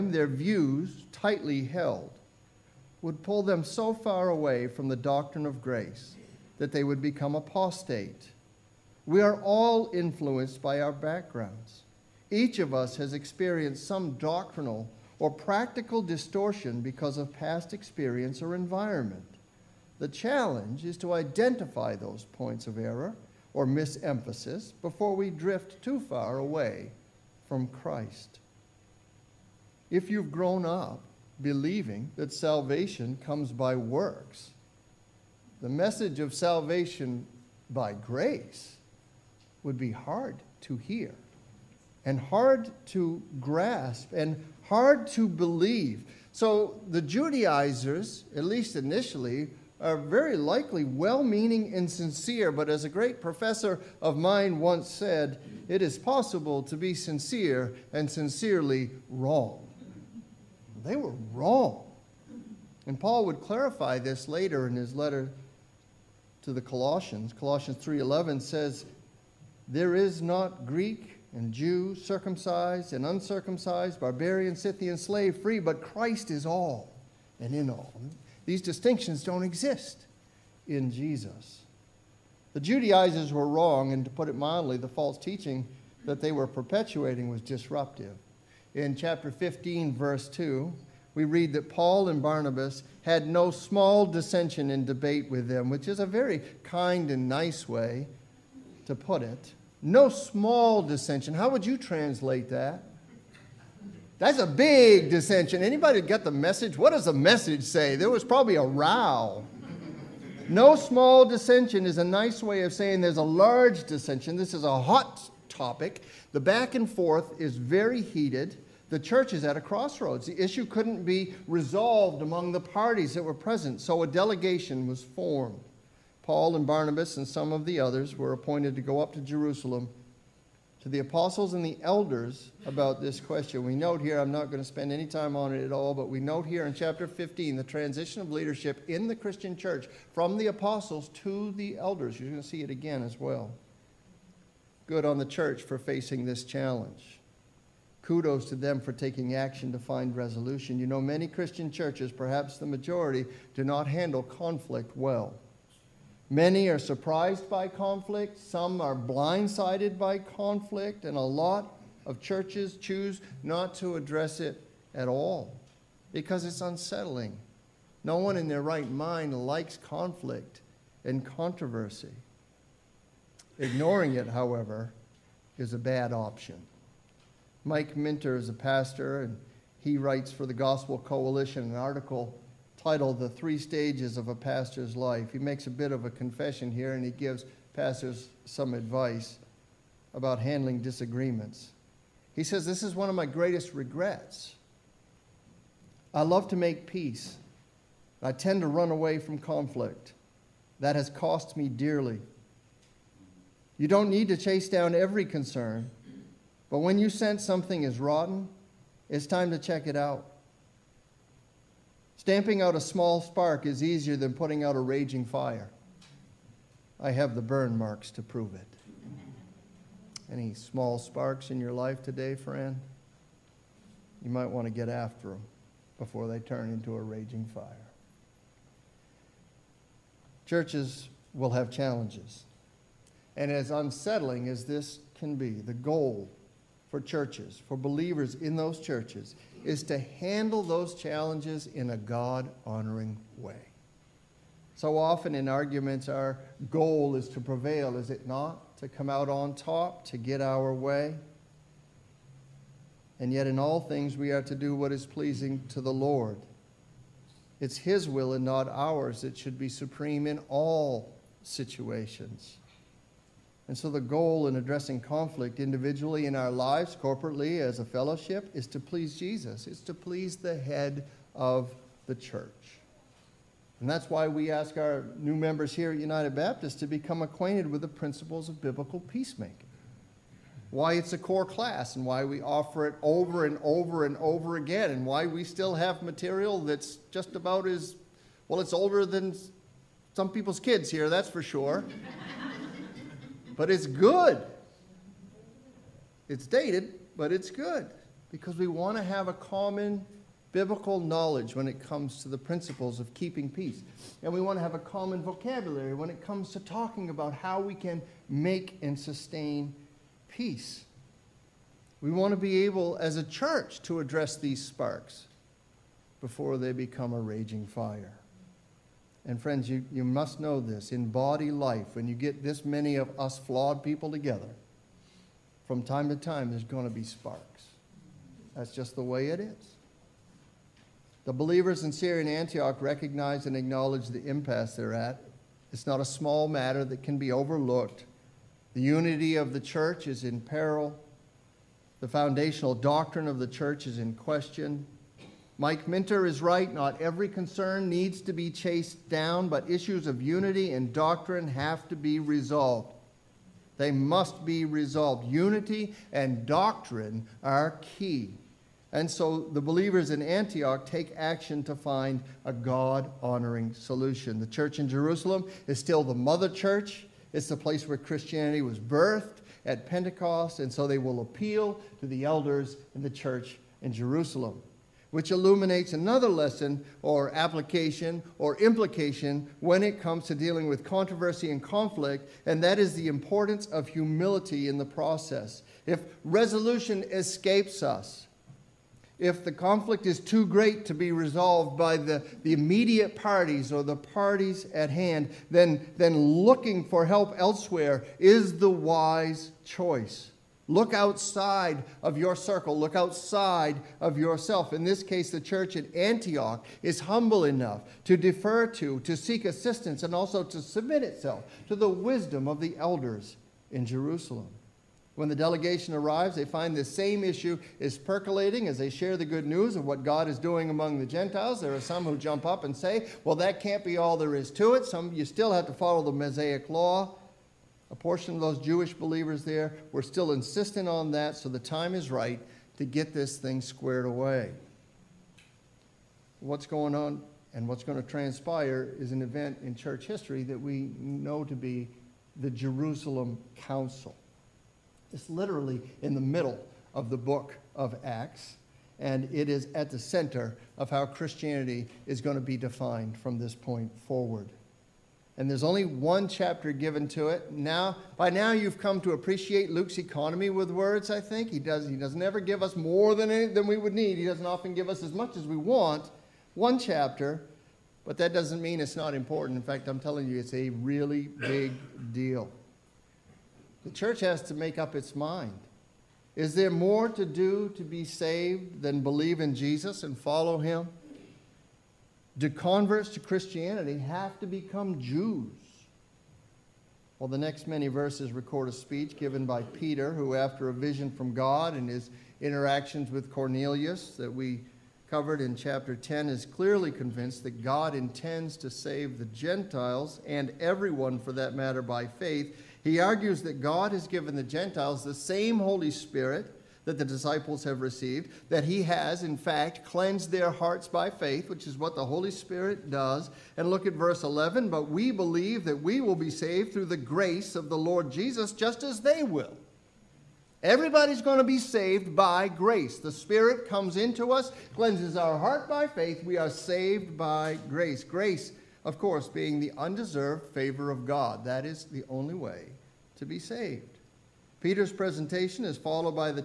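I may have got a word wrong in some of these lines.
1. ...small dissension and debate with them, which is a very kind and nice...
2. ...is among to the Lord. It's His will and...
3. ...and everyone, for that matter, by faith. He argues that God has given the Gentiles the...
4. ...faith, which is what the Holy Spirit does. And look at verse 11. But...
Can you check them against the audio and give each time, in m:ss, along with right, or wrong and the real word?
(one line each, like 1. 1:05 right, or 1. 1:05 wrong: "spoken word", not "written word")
1. 1:33 right
2. 4:14 wrong: "pleasing", not "among"
3. 8:20 right
4. 8:31 right.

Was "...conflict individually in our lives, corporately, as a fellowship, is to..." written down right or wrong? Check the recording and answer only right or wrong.
right.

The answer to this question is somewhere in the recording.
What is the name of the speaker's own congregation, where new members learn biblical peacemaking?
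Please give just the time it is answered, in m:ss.
4:36.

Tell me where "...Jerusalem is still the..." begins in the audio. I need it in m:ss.
6:04.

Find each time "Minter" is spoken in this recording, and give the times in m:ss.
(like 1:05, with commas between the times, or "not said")
2:57, 5:45.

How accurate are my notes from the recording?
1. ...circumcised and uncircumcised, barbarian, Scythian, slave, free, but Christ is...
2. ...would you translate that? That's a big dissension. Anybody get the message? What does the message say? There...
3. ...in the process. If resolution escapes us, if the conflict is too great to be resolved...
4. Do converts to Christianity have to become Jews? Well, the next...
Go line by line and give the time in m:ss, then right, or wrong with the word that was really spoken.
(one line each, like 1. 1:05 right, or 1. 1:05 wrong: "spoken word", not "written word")
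1. 1:11 right
2. 1:41 right
3. 6:24 right
4. 8:02 right.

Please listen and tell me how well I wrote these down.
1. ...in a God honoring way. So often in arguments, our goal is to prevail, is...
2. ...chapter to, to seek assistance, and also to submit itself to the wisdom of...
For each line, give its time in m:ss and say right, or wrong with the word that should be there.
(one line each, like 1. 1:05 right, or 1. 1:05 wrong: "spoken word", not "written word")
1. 4:01 right
2. 6:48 wrong: "defer", not "chapter".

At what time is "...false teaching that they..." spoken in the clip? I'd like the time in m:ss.
1:24.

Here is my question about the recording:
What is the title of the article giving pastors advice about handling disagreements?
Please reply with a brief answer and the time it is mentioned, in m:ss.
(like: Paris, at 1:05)
The Three Stages of a Pastor's Life, at 3:03.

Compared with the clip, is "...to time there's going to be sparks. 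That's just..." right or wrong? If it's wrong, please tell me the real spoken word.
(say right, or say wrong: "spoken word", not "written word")
right.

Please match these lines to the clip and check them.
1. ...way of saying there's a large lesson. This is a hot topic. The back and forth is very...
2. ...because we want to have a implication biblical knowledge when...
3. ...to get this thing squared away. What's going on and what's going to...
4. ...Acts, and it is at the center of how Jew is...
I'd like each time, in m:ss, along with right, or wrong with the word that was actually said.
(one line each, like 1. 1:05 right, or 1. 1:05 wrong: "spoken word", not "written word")
1. 1:52 wrong: "dissension", not "lesson"
2. 4:58 wrong: "common", not "implication"
3. 7:12 right
4. 7:28 wrong: "Christianity", not "Jew".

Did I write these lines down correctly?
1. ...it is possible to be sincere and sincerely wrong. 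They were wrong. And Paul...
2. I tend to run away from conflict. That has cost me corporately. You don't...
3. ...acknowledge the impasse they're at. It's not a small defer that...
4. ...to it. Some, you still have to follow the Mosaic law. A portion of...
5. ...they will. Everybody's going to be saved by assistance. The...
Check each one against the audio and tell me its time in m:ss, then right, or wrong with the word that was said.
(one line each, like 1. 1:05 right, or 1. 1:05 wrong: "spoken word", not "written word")
1. 0:55 right
2. 3:18 wrong: "dearly", not "corporately"
3. 5:33 wrong: "matter", not "defer"
4. 7:04 right
5. 8:39 wrong: "grace", not "assistance".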